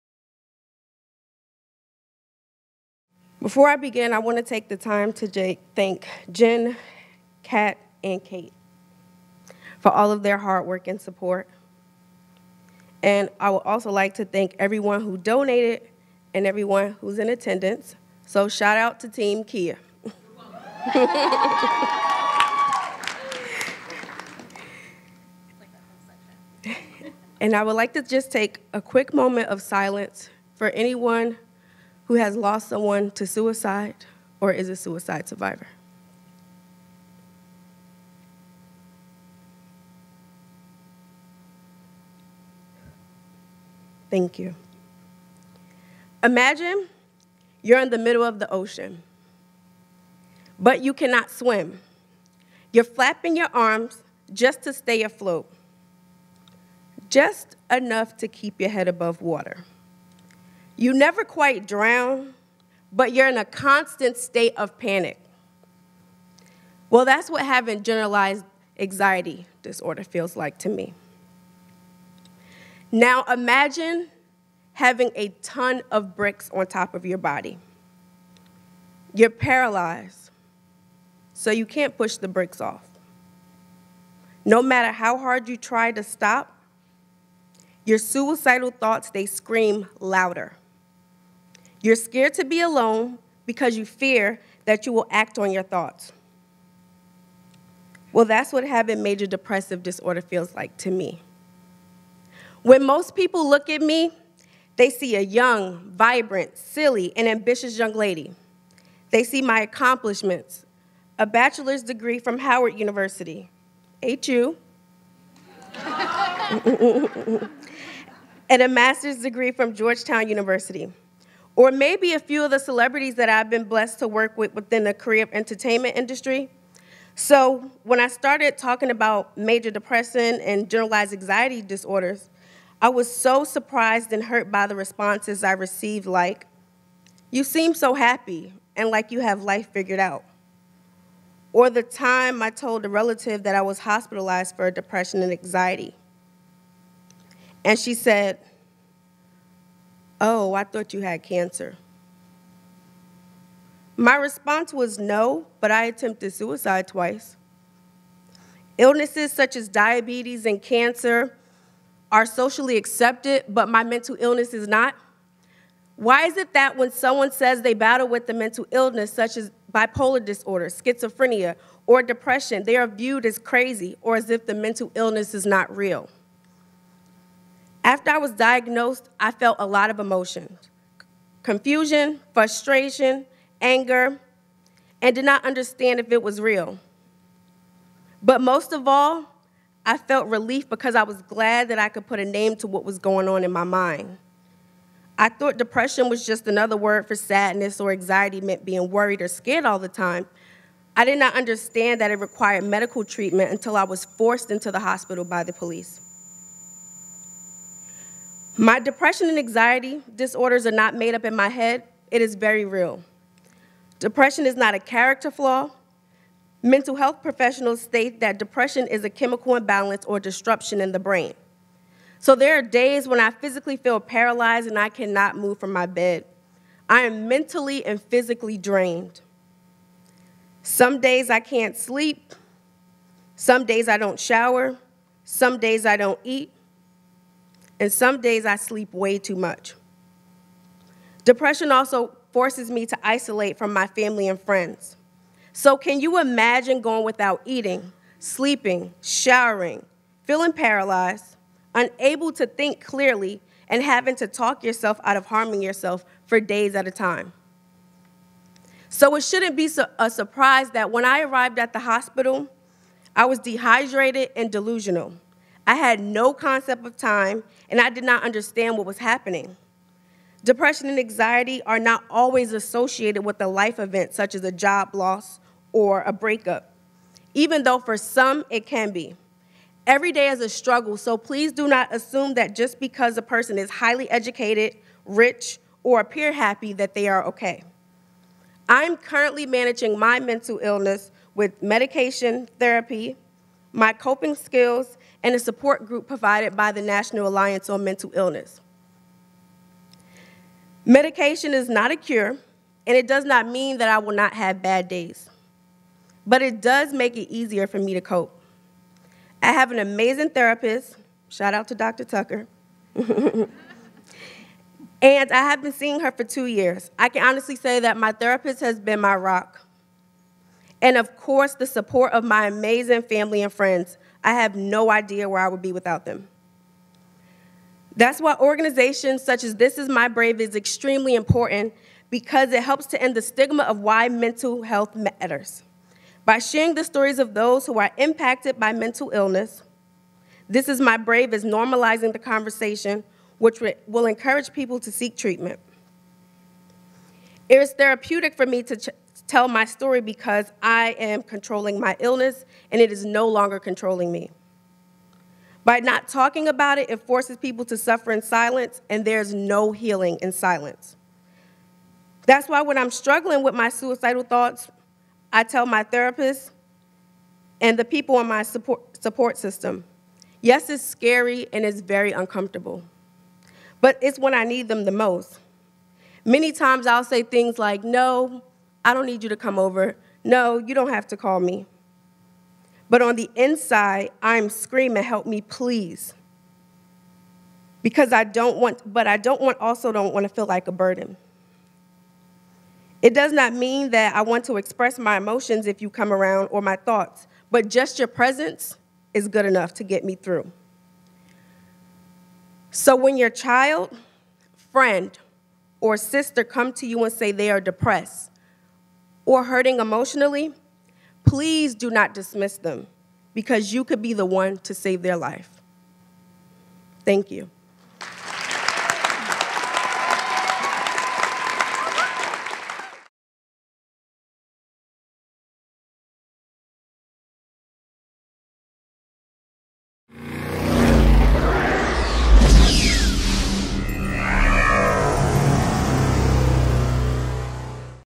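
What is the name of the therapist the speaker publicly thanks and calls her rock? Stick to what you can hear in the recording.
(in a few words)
Dr. Tucker.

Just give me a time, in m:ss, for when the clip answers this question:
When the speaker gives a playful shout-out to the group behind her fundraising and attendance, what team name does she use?
0:19.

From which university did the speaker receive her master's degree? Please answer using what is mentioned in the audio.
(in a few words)
Georgetown University.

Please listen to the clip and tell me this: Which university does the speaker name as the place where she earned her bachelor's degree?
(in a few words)
Howard University.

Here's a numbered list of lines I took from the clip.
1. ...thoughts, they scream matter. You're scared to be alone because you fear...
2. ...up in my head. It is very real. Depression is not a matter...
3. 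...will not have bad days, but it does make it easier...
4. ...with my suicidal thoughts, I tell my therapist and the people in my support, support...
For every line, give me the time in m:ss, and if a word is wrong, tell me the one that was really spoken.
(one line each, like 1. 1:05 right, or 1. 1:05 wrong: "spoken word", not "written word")
1. 1:28 wrong: "louder", not "matter"
2. 3:31 wrong: "character", not "matter"
3. 5:03 right
4. 6:03 right.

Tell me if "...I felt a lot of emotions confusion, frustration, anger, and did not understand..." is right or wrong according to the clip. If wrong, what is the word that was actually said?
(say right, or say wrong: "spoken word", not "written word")
right.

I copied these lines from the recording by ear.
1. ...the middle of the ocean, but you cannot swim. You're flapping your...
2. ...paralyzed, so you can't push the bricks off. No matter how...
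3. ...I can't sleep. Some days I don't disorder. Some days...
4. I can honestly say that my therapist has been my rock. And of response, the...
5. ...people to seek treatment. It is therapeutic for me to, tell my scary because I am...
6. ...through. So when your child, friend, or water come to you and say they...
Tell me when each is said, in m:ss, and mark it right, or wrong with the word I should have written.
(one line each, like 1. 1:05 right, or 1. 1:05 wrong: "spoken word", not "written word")
1. 0:47 right
2. 1:19 right
3. 3:51 wrong: "shower", not "disorder"
4. 5:16 wrong: "course", not "response"
5. 5:44 wrong: "story", not "scary"
6. 6:40 wrong: "sister", not "water".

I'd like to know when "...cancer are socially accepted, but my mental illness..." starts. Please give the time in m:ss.
2:40.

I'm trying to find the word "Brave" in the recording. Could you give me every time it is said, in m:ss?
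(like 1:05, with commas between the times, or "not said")
5:30, 5:40.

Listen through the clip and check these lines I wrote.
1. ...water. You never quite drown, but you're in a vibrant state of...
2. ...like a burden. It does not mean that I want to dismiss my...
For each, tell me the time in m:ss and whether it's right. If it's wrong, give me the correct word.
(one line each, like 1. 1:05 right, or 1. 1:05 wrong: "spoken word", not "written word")
1. 0:59 wrong: "constant", not "vibrant"
2. 6:30 wrong: "express", not "dismiss".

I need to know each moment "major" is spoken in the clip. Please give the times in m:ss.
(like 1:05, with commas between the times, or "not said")
1:39, 2:09.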